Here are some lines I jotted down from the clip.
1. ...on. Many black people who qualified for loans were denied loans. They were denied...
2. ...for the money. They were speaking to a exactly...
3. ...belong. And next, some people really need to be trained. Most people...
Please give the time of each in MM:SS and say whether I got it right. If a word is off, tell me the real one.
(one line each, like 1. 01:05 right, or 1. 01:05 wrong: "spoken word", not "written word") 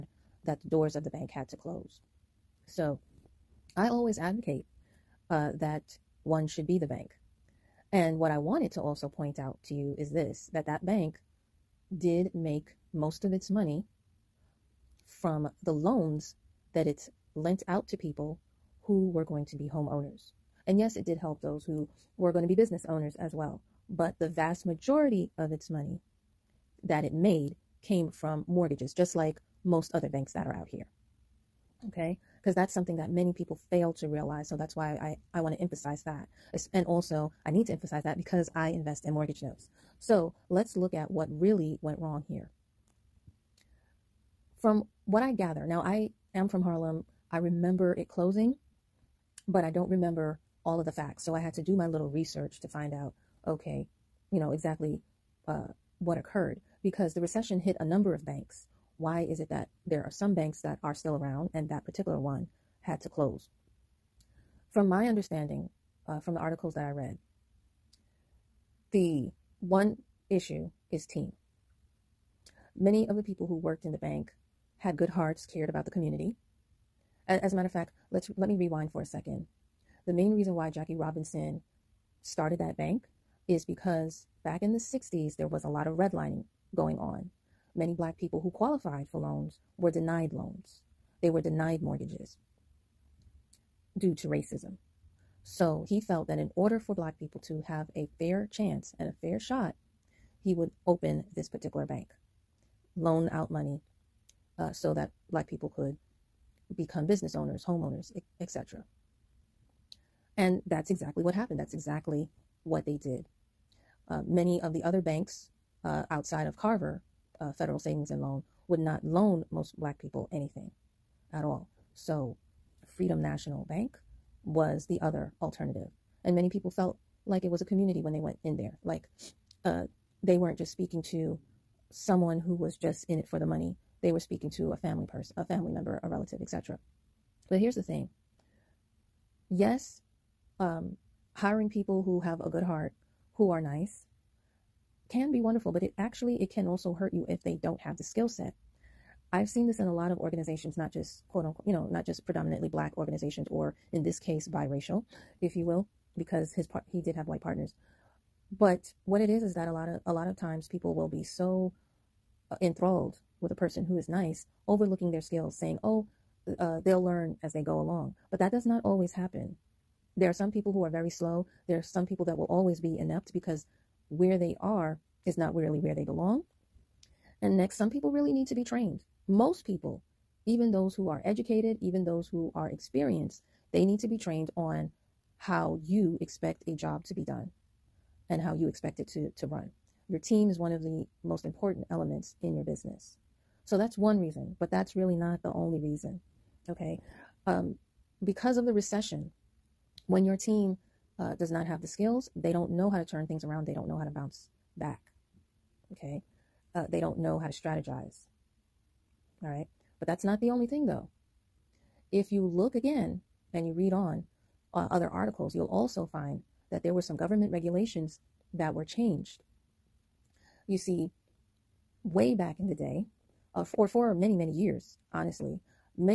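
1. 01:26 right
2. 02:13 wrong: "family", not "exactly"
3. 02:56 right.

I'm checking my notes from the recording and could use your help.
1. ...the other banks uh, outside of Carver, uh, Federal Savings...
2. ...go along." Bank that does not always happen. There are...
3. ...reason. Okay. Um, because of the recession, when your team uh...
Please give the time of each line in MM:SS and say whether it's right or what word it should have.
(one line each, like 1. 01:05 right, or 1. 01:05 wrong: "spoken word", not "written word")
1. 01:54 right
2. 02:47 wrong: "But", not "Bank"
3. 03:15 right.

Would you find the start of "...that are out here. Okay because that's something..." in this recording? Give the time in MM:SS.
00:30.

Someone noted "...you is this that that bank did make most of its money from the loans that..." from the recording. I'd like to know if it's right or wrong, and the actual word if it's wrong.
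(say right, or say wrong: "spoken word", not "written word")
right.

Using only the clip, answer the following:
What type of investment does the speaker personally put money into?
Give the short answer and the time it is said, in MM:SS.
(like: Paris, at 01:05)
mortgage notes, at 00:39.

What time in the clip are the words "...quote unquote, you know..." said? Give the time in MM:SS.
02:31.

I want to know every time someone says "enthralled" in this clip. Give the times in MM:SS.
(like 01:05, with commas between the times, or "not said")
02:42.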